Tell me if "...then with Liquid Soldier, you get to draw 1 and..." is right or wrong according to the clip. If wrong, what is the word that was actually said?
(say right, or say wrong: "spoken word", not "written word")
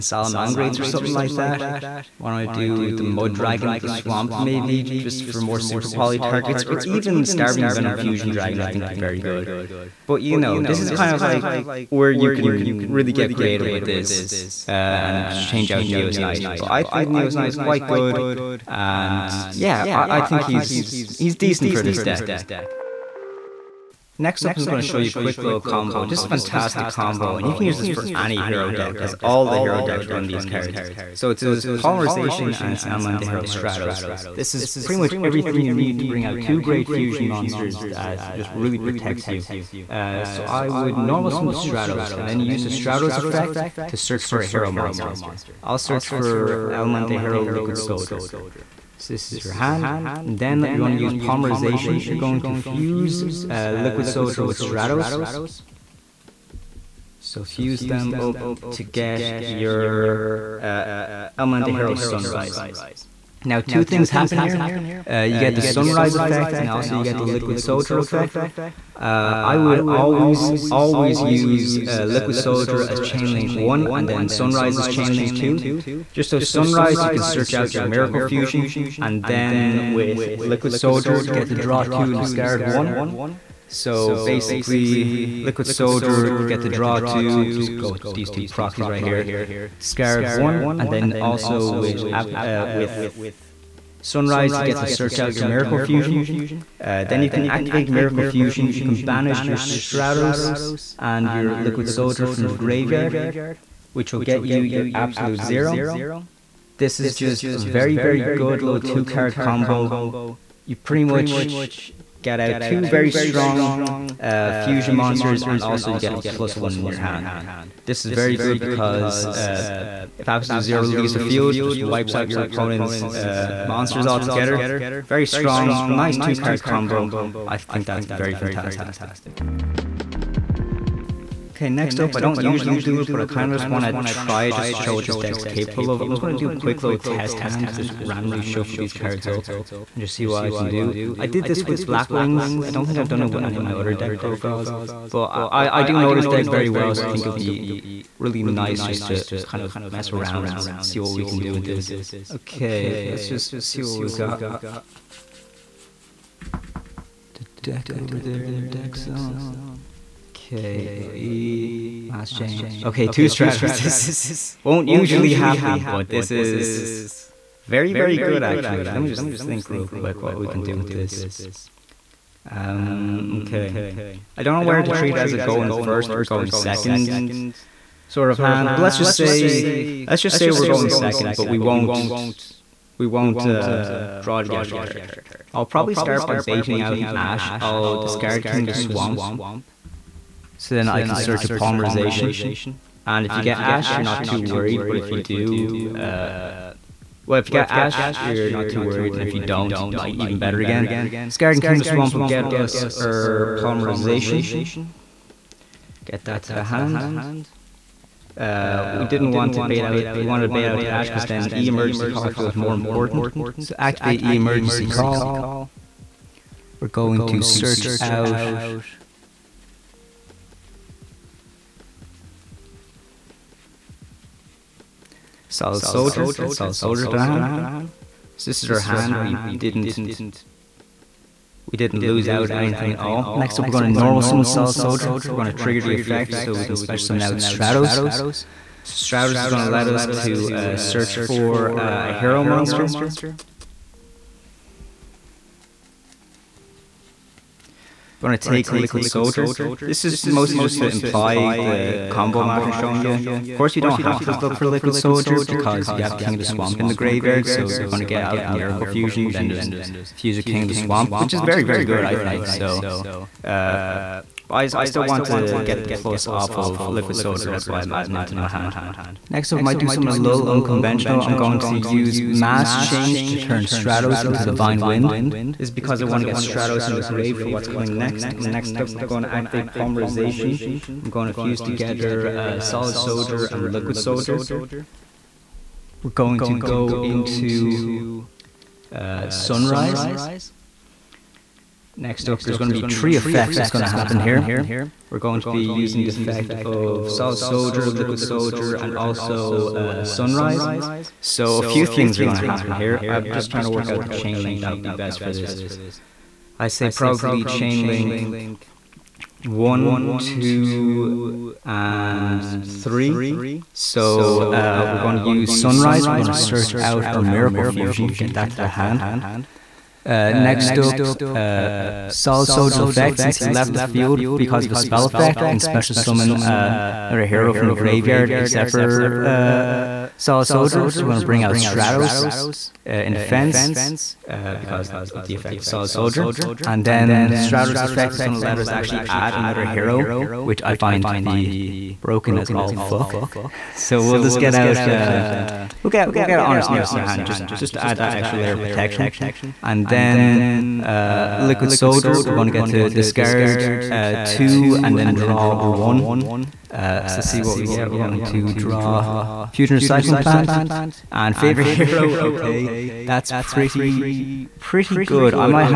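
wrong: "2", not "1".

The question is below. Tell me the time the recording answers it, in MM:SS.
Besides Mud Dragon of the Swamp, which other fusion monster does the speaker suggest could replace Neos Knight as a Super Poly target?
00:07.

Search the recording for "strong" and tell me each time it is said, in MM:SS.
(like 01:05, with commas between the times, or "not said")
01:53, 02:05.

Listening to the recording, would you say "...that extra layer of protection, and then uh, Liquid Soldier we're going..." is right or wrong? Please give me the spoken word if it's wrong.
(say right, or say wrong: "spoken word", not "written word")
right.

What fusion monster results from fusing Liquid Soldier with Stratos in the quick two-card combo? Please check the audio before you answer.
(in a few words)
Elemental Hero Sunrise.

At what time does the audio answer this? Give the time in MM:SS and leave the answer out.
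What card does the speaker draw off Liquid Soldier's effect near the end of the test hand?
05:59.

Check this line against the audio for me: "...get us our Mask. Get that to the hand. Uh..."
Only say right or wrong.
wrong.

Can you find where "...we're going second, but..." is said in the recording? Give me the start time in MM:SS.
03:00.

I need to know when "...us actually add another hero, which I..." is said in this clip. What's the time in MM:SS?
05:38.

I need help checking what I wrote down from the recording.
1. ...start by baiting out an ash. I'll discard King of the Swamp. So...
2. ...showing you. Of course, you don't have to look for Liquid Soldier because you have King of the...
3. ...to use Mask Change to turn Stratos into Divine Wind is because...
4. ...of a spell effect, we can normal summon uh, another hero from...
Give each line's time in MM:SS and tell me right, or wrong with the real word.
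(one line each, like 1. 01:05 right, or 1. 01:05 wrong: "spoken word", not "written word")
1. 03:05 right
2. 04:12 right
3. 04:31 right
4. 05:24 wrong: "special", not "normal".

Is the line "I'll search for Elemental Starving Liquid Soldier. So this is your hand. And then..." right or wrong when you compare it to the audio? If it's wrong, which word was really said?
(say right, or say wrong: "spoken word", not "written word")
wrong: "Hero", not "Starving".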